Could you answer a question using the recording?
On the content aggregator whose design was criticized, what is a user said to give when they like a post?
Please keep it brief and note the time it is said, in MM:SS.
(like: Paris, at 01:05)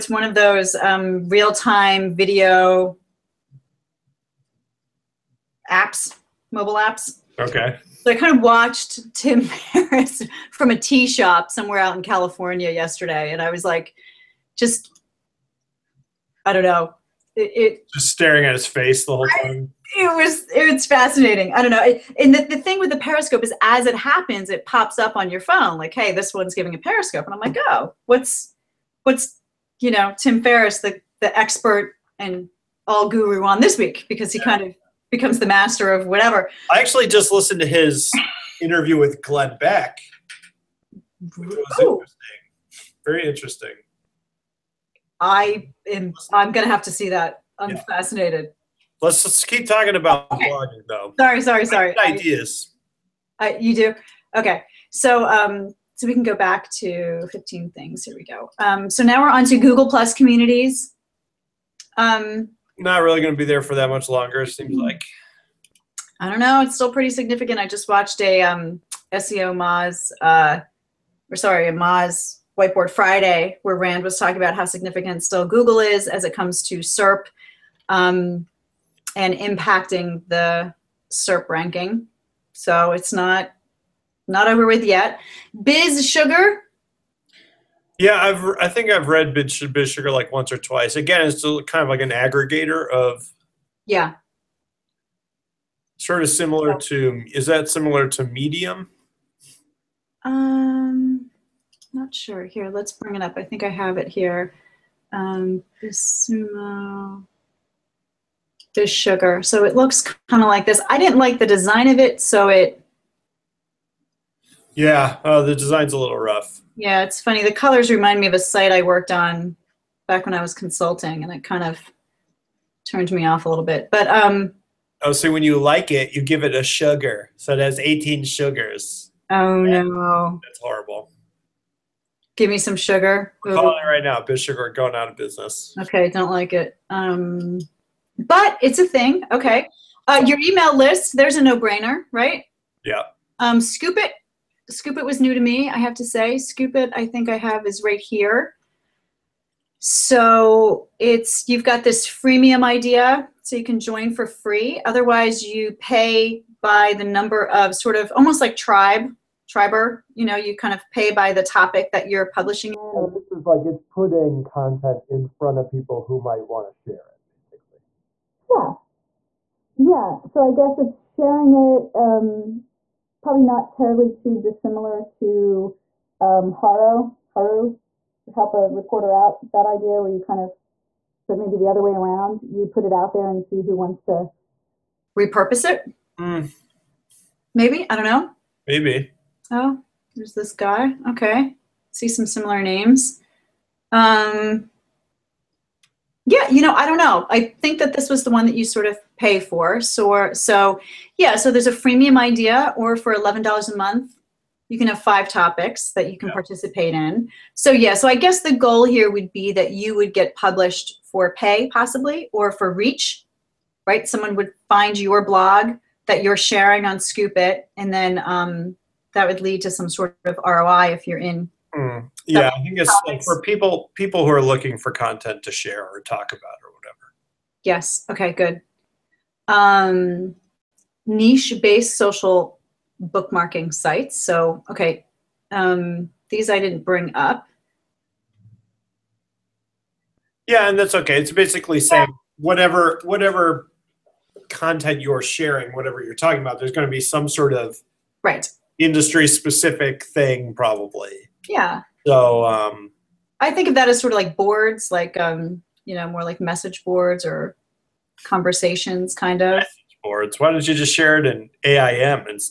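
a sugar, at 02:06.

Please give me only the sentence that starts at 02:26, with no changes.
Scoop It, I think I have, is right here.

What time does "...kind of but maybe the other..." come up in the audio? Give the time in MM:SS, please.
03:00.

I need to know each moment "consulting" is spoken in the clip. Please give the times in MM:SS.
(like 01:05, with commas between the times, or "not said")
02:00.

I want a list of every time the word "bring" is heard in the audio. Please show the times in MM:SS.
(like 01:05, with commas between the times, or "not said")
01:42, 03:56.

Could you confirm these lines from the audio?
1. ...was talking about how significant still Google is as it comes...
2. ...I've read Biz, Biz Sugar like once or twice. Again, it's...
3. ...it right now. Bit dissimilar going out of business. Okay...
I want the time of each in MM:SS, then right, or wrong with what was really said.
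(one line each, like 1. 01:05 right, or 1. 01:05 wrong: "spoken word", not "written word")
1. 01:14 right
2. 01:28 right
3. 02:13 wrong: "sugar", not "dissimilar".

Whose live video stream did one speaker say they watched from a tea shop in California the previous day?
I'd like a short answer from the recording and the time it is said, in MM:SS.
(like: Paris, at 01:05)
Tim Ferriss, at 00:09.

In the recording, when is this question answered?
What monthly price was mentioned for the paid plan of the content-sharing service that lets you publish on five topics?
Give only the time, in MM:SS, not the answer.
03:23.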